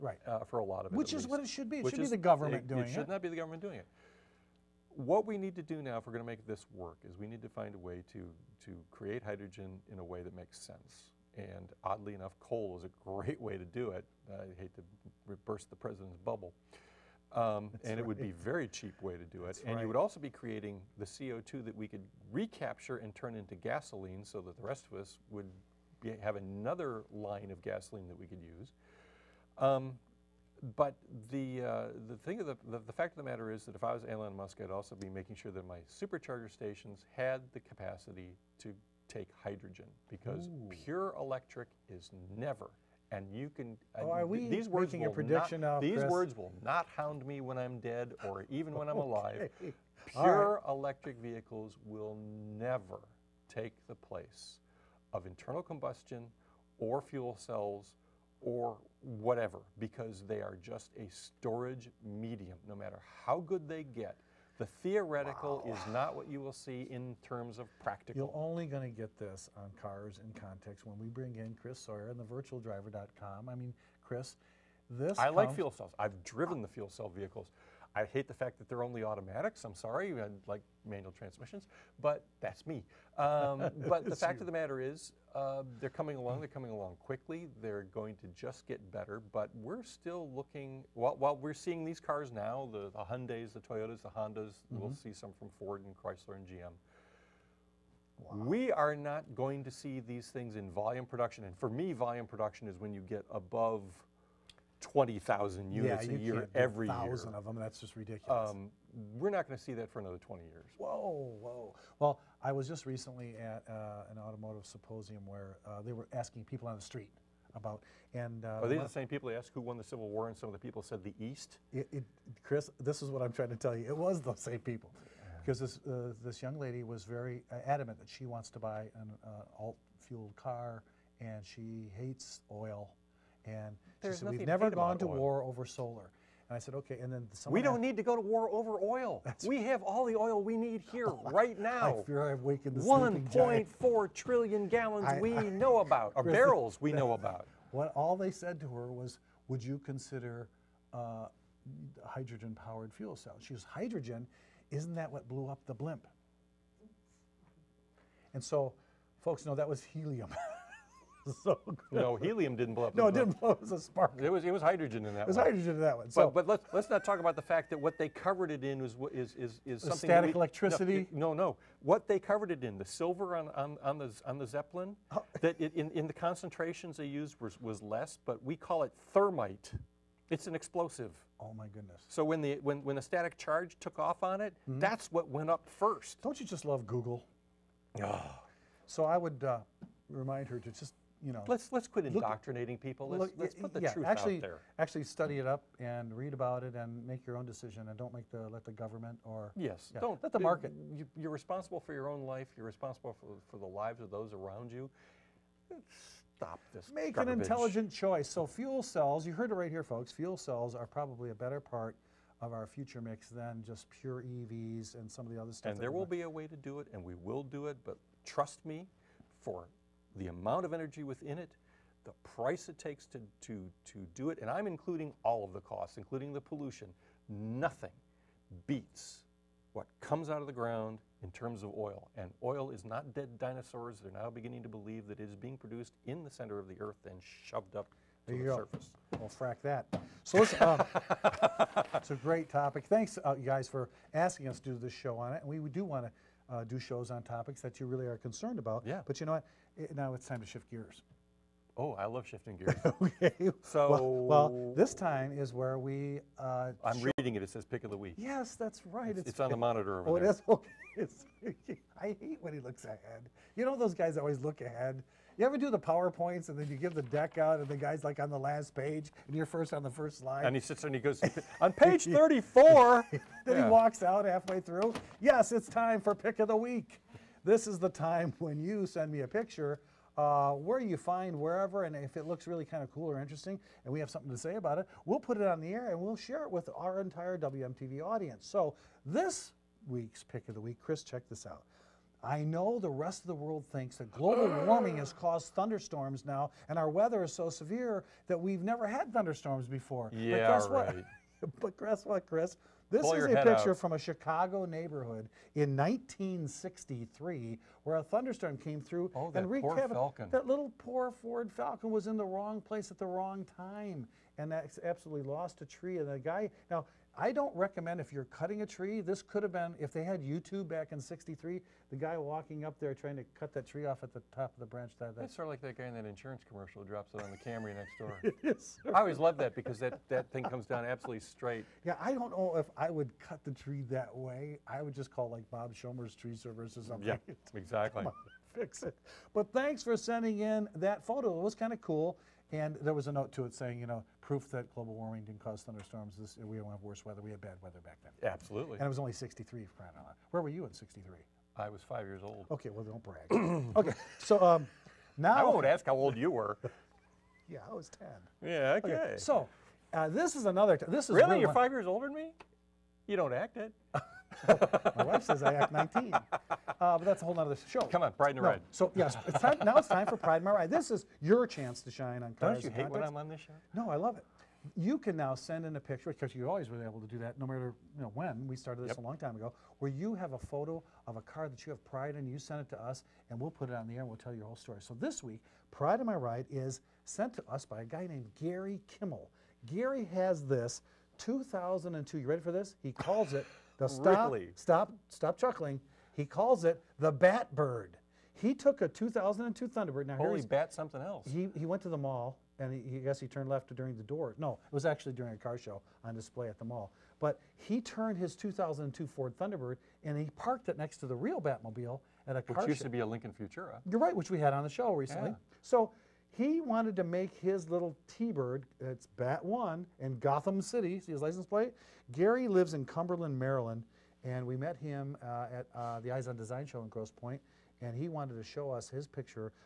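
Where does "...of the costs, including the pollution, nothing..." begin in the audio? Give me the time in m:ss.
3:45.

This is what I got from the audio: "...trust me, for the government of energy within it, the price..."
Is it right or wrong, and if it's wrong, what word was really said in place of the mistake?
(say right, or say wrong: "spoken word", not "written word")
wrong: "amount", not "government".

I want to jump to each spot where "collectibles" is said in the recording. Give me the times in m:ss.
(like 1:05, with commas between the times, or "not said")
not said.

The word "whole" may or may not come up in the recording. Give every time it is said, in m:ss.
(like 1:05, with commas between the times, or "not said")
6:07, 6:24.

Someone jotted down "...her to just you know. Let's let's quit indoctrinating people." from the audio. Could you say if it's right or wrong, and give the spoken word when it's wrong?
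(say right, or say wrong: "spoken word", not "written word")
right.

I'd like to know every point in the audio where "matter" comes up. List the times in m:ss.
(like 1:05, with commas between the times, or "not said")
0:33, 1:02, 1:24, 6:17.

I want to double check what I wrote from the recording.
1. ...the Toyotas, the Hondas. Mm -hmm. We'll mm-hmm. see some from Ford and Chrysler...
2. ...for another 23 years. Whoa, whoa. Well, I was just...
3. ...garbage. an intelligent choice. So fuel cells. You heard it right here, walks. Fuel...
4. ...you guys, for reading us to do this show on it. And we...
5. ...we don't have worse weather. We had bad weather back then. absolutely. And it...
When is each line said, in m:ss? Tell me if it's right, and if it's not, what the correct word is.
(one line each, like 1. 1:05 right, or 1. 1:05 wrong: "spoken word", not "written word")
1. 1:33 right
2. 1:49 wrong: "20", not "23"
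3. 3:27 wrong: "folks", not "walks"
4. 4:03 wrong: "asking", not "reading"
5. 5:46 right.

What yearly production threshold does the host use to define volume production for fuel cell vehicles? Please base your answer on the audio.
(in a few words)
20,000 units.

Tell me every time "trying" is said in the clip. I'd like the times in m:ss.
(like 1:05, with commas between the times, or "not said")
2:03, 5:22.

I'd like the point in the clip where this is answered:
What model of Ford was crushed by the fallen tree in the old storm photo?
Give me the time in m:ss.
5:11.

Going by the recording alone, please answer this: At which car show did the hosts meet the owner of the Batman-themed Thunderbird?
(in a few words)
Eyes on Design.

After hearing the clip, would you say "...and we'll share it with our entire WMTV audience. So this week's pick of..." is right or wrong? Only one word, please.
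right.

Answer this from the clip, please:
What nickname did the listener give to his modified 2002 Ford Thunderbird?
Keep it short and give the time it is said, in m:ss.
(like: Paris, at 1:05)
Bat Bird, at 6:37.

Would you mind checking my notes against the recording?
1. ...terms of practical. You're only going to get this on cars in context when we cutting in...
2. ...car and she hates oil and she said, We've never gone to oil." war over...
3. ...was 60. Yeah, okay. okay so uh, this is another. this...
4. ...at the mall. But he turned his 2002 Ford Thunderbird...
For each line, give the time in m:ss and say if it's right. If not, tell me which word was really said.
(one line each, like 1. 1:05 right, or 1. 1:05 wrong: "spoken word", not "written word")
1. 1:07 wrong: "bring", not "cutting"
2. 2:10 right
3. 5:57 wrong: "10", not "60"
4. 6:46 right.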